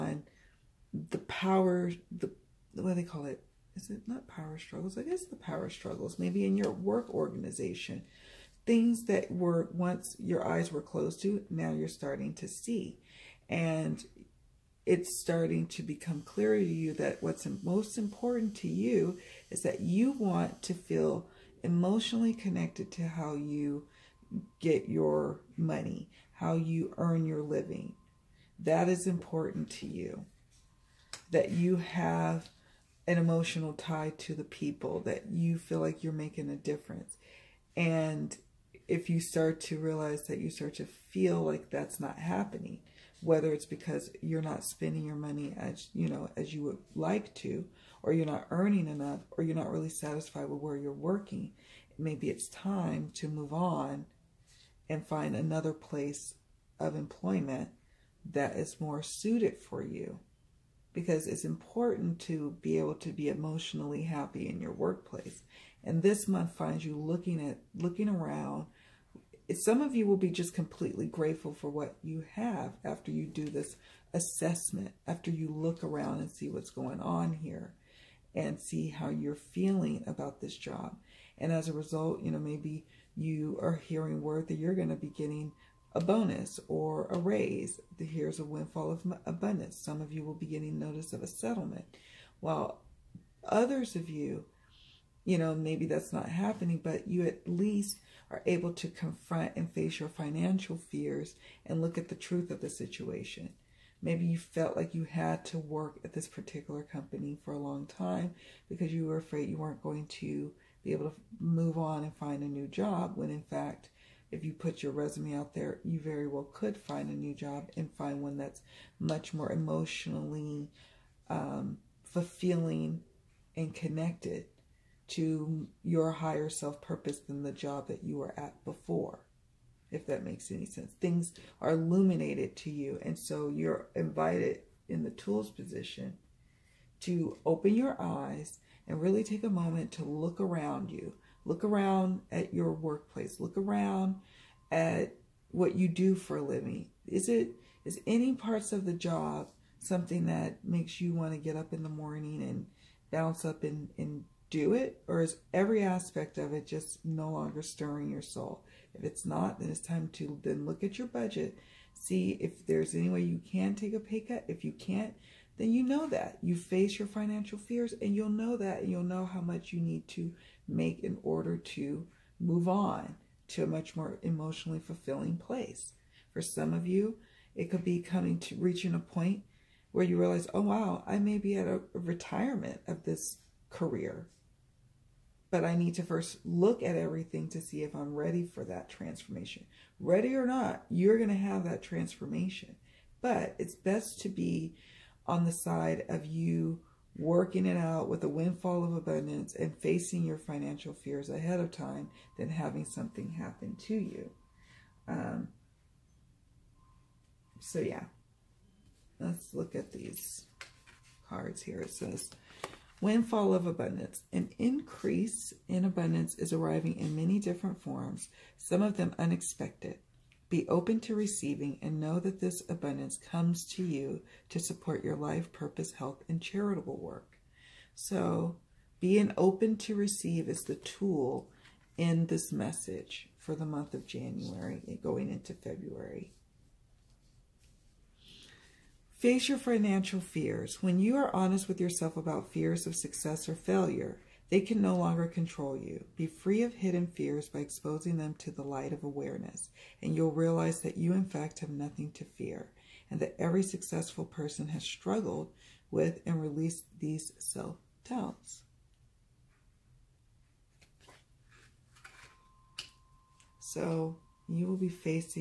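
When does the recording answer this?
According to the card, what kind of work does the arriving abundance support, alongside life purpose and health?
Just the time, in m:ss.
3:46.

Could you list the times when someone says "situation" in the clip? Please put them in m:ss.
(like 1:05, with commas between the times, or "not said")
1:42.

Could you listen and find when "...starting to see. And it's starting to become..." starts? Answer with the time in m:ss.
0:11.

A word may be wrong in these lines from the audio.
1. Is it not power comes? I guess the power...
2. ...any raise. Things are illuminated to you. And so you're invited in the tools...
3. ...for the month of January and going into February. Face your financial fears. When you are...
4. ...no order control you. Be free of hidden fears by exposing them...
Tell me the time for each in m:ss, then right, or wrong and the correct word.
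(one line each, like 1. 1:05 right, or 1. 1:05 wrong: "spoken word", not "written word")
1. 0:03 wrong: "struggles", not "comes"
2. 2:10 wrong: "sense", not "raise"
3. 3:53 right
4. 4:04 wrong: "longer", not "order".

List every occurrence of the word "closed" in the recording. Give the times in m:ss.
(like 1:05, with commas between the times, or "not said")
0:10.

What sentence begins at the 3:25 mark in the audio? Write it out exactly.
Um, so yeah, let's look at these cards here.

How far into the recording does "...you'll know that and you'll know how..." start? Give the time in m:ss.
2:48.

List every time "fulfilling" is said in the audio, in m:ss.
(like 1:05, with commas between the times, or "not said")
2:02, 2:54.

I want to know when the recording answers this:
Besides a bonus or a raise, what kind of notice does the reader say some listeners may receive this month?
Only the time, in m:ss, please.
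1:31.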